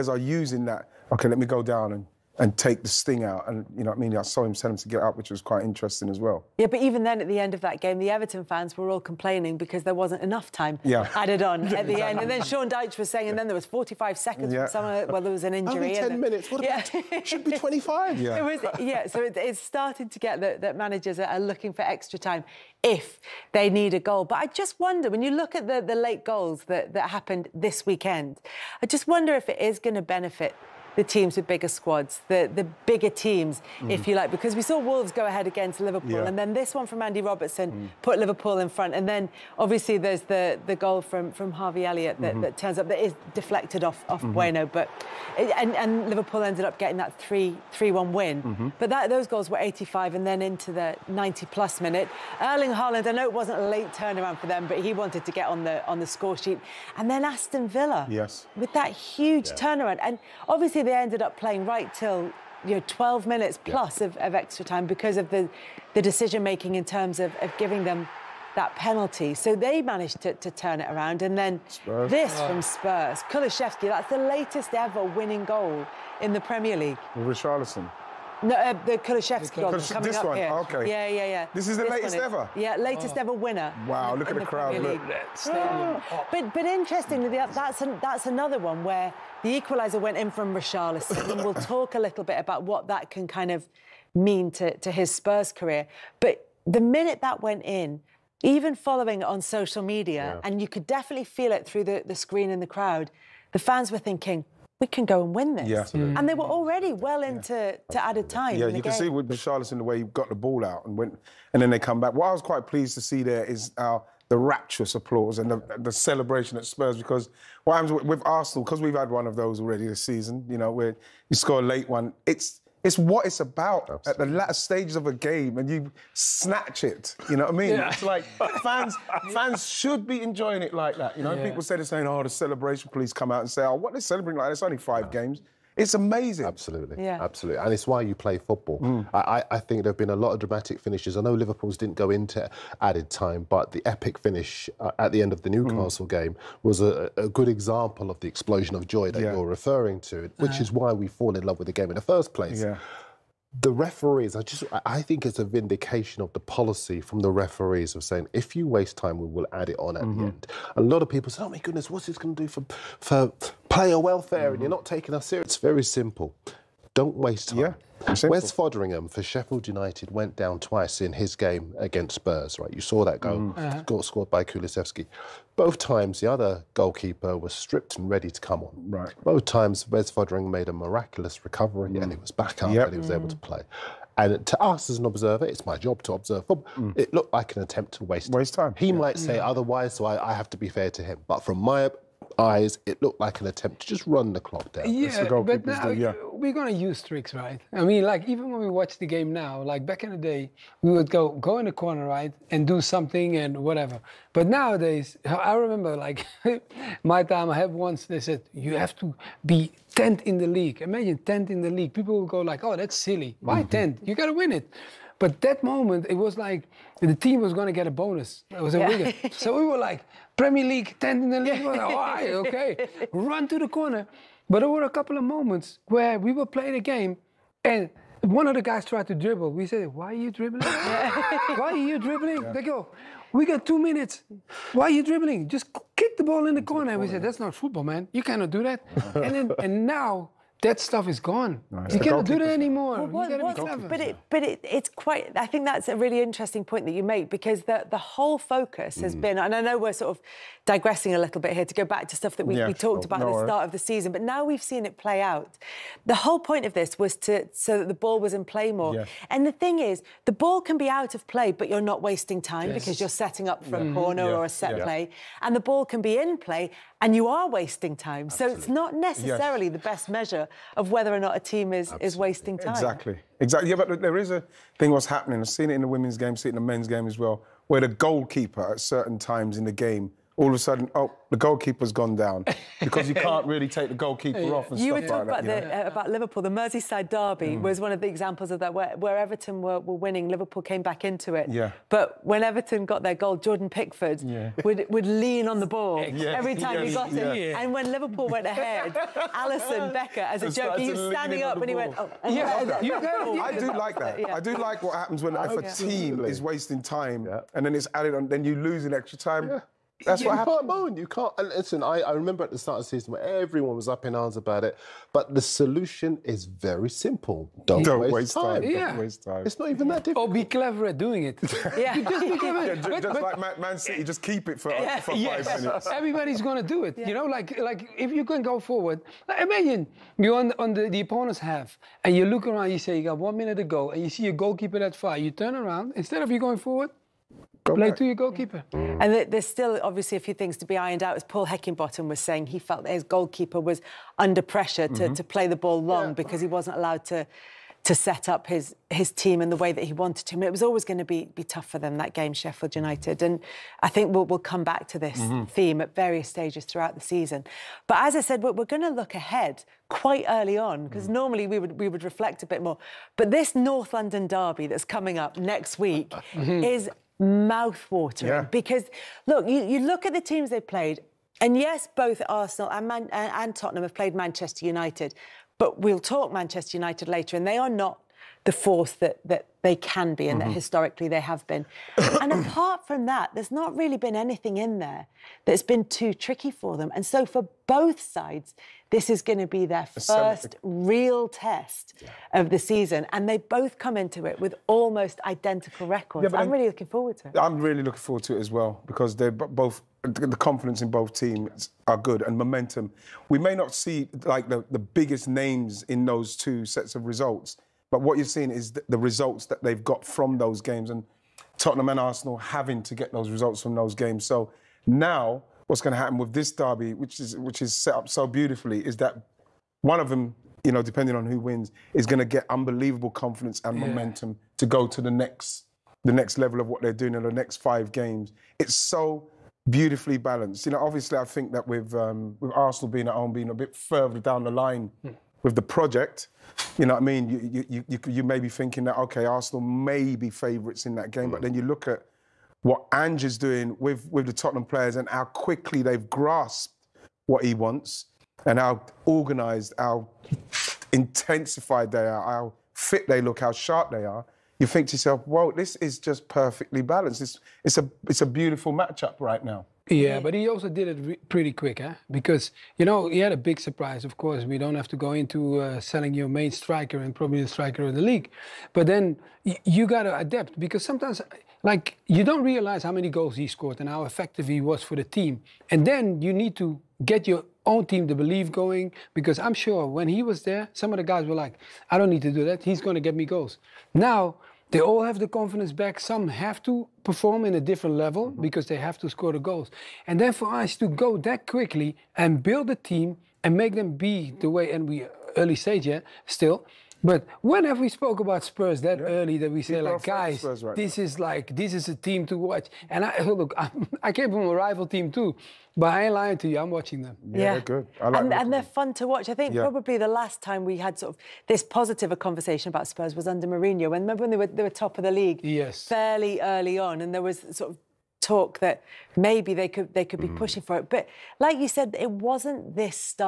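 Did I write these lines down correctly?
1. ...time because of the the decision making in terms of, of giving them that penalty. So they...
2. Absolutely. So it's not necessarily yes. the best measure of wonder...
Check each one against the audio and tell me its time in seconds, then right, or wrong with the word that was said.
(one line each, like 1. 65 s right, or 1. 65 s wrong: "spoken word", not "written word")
1. 64 s right
2. 268 s wrong: "whether", not "wonder".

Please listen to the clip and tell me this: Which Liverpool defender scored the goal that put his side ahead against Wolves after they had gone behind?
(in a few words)
Andy Robertson.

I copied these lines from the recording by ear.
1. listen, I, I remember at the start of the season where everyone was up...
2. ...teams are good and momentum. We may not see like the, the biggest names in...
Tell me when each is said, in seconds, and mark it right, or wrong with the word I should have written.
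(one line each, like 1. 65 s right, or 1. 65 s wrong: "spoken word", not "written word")
1. 311 s right
2. 401 s right.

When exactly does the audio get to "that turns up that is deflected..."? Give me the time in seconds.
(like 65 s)
42 s.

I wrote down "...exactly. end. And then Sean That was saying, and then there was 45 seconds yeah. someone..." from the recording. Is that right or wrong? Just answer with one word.
wrong.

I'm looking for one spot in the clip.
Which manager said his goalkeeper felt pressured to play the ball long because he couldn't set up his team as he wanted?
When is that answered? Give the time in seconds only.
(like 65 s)
341 s.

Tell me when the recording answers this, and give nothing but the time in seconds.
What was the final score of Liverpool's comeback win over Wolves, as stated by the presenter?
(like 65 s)
47 s.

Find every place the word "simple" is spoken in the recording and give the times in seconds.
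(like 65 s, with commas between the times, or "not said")
165 s, 316 s.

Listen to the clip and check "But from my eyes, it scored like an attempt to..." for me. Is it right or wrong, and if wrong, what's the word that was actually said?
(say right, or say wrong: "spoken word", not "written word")
wrong: "looked", not "scored".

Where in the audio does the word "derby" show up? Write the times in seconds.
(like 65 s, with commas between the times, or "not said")
287 s, 364 s, 416 s.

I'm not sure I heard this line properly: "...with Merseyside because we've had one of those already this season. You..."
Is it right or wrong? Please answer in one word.
wrong.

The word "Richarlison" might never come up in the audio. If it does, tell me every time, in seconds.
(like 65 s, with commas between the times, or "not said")
77 s, 90 s.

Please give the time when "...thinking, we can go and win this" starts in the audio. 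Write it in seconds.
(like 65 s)
103 s.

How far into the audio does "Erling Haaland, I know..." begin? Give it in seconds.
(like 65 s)
52 s.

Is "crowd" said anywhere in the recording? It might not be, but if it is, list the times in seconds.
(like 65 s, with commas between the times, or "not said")
84 s, 102 s.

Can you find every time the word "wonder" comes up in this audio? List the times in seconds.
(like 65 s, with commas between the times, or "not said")
24 s, 29 s.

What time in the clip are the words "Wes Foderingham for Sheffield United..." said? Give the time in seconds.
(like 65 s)
168 s.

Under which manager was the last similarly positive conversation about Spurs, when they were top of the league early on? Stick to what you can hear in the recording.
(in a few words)
Mourinho.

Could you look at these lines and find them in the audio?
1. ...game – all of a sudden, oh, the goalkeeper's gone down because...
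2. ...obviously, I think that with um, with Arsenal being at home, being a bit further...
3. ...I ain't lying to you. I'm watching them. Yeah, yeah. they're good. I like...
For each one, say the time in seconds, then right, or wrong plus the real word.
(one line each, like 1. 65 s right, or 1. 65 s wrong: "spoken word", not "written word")
1. 279 s right
2. 430 s right
3. 505 s right.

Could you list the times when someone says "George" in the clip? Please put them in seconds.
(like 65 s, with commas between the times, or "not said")
not said.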